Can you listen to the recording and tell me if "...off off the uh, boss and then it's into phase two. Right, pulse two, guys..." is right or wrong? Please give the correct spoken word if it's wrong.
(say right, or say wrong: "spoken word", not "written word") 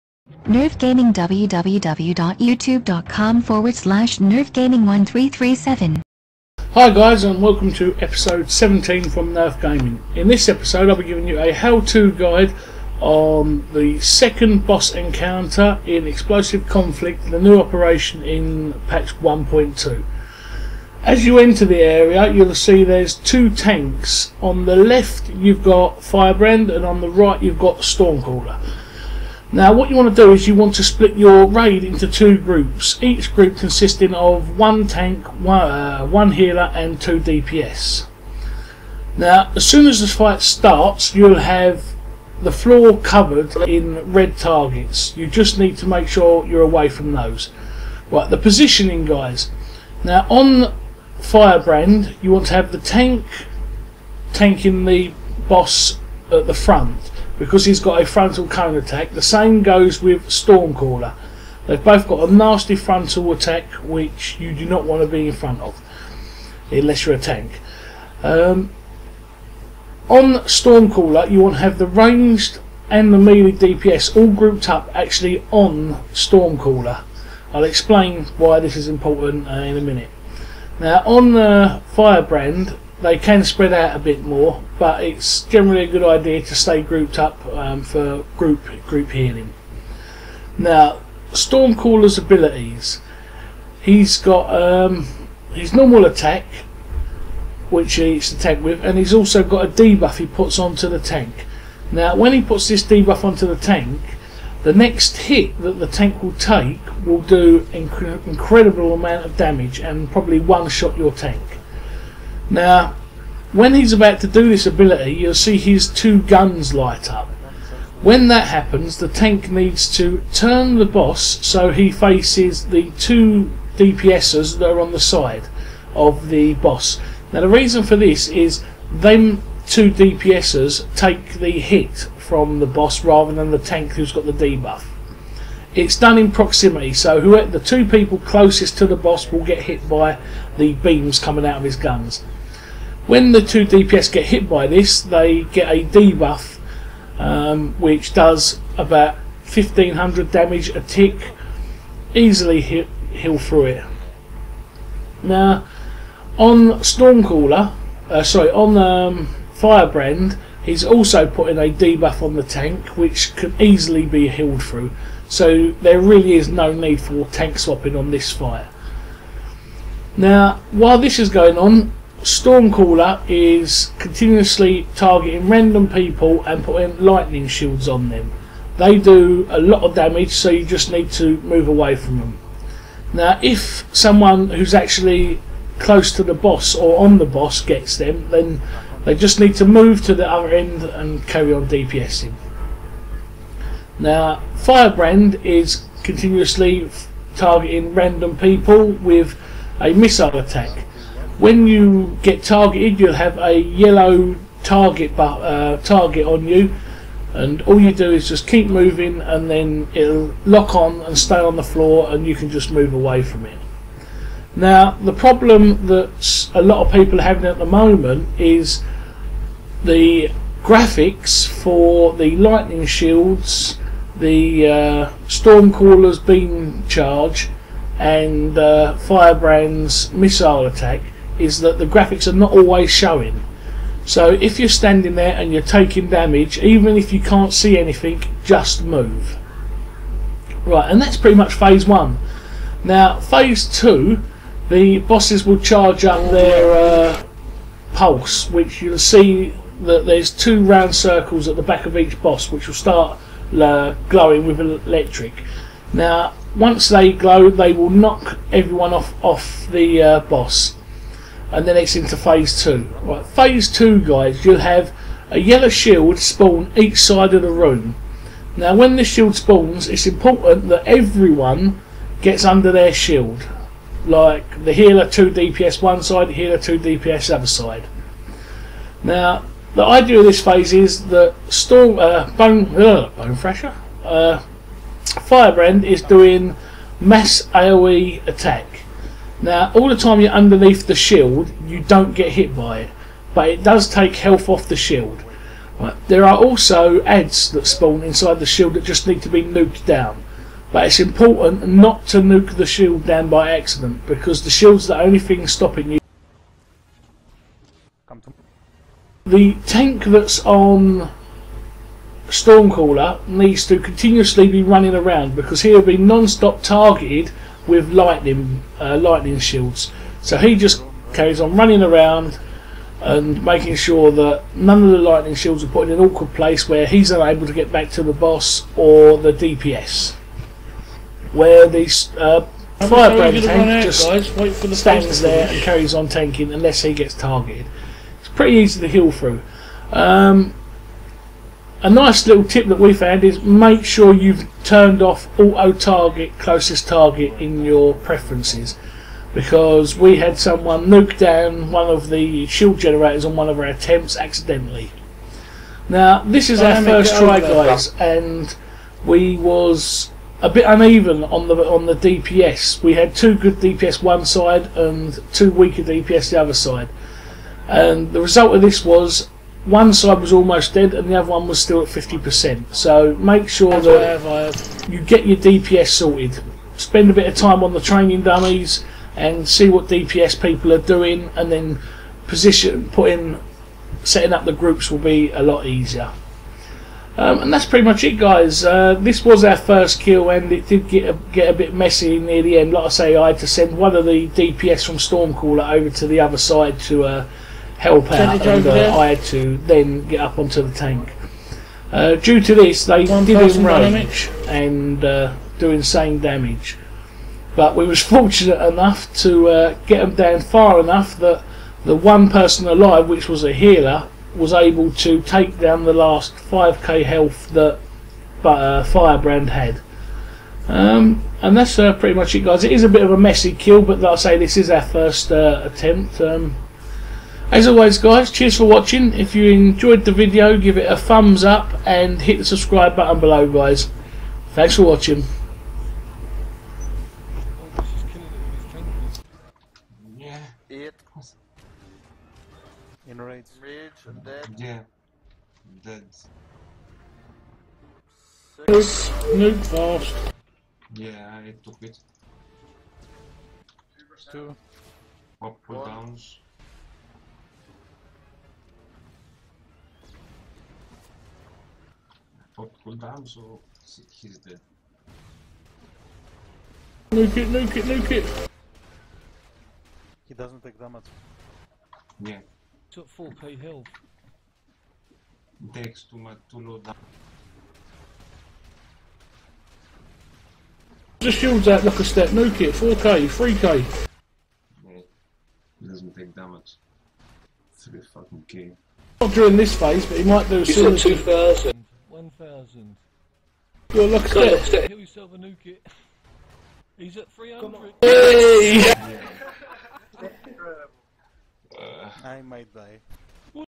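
wrong: "phase", not "pulse".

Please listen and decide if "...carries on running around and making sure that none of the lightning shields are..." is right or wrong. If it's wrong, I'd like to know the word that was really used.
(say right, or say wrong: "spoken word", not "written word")
right.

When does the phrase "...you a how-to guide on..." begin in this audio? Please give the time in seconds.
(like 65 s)
11 s.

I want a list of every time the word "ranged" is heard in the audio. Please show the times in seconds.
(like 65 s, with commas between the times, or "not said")
71 s.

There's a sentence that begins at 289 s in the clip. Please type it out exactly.
Now, all the time you're underneath the shield, you don't get hit by it, but it does take health off the shield.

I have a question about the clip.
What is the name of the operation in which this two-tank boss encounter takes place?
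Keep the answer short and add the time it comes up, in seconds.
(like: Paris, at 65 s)
Explosive Conflict, at 16 s.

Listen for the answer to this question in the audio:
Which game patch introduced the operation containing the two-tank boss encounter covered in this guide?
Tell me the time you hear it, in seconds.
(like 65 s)
18 s.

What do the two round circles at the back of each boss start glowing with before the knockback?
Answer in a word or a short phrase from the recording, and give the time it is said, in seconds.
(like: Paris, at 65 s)
electric, at 254 s.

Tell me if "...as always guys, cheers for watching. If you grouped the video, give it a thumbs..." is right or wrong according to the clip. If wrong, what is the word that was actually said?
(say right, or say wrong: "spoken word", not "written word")
wrong: "enjoyed", not "grouped".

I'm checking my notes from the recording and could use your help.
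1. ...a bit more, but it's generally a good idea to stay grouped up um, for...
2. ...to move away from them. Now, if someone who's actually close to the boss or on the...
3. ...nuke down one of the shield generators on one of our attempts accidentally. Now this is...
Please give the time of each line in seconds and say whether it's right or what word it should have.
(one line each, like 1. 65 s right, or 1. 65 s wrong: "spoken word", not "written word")
1. 83 s right
2. 181 s right
3. 350 s right.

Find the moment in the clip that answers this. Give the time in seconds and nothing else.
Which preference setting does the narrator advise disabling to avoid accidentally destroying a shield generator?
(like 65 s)
345 s.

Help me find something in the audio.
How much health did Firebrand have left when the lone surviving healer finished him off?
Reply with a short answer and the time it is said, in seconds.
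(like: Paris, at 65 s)
5k, at 416 s.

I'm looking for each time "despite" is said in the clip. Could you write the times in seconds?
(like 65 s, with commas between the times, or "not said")
not said.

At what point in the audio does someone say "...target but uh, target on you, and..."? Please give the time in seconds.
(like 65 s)
204 s.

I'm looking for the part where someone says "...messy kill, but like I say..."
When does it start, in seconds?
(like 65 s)
423 s.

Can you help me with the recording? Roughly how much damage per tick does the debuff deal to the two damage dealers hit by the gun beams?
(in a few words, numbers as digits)
1500.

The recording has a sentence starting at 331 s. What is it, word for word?
Where these uh, firebrand tank just guys, the stands there and carries on tanking unless he gets targeted.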